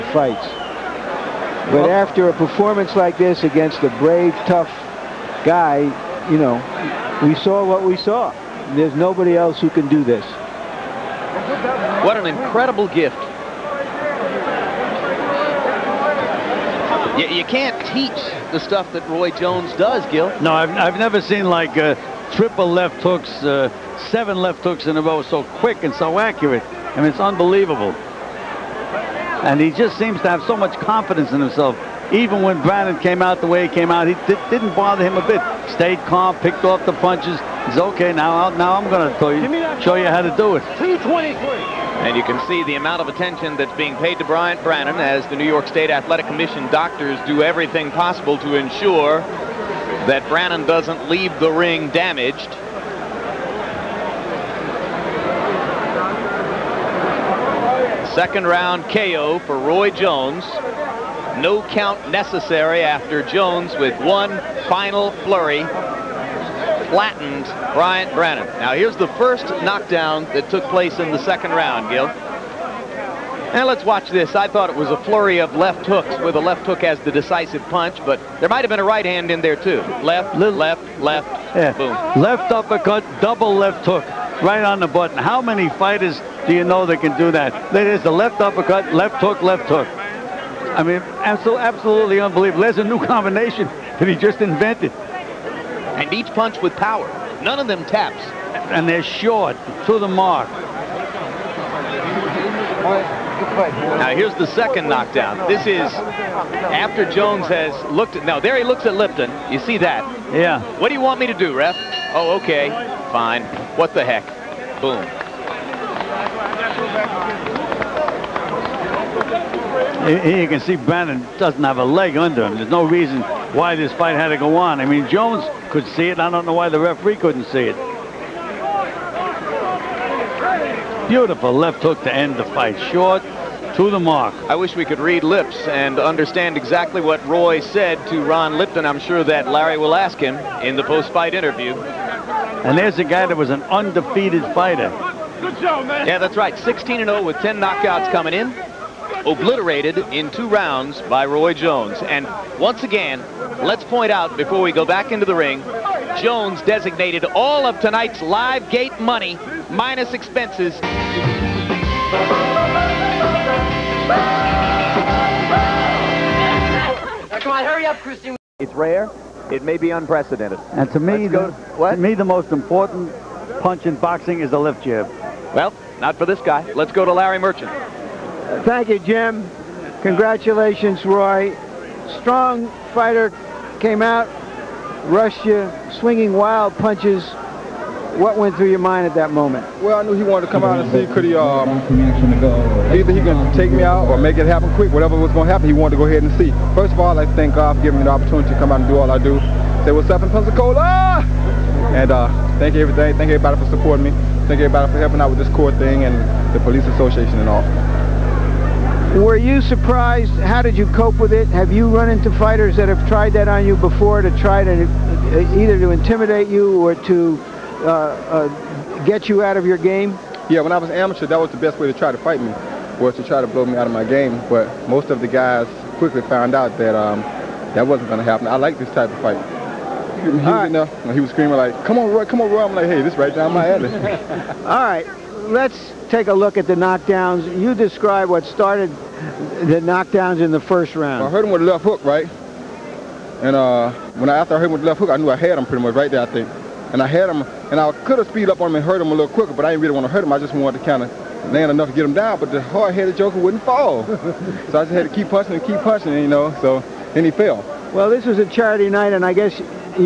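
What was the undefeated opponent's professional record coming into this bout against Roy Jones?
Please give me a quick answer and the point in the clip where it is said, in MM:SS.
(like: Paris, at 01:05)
16 and 0, at 02:26.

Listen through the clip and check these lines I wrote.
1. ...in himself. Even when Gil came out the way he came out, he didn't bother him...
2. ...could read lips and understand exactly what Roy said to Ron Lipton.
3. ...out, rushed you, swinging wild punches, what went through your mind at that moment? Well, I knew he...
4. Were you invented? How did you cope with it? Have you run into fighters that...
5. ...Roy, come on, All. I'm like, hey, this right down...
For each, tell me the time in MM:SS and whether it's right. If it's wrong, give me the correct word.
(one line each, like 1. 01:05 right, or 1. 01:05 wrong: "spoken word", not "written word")
1. 00:31 wrong: "Brannon", not "Gil"
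2. 02:14 right
3. 03:04 right
4. 03:29 wrong: "surprised", not "invented"
5. 03:52 wrong: "Roy", not "All".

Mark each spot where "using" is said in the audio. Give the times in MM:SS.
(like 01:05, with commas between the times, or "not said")
not said.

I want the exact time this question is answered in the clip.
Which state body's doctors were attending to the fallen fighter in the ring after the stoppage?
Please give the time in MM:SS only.
00:45.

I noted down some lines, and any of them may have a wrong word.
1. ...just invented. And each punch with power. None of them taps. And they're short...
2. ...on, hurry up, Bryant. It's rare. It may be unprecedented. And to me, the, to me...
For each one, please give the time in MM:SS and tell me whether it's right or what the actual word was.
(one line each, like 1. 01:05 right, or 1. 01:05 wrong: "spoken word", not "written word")
1. 01:34 right
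2. 02:47 wrong: "Christine", not "Bryant".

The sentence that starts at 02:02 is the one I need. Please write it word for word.
There's no reason why this fight had to go on.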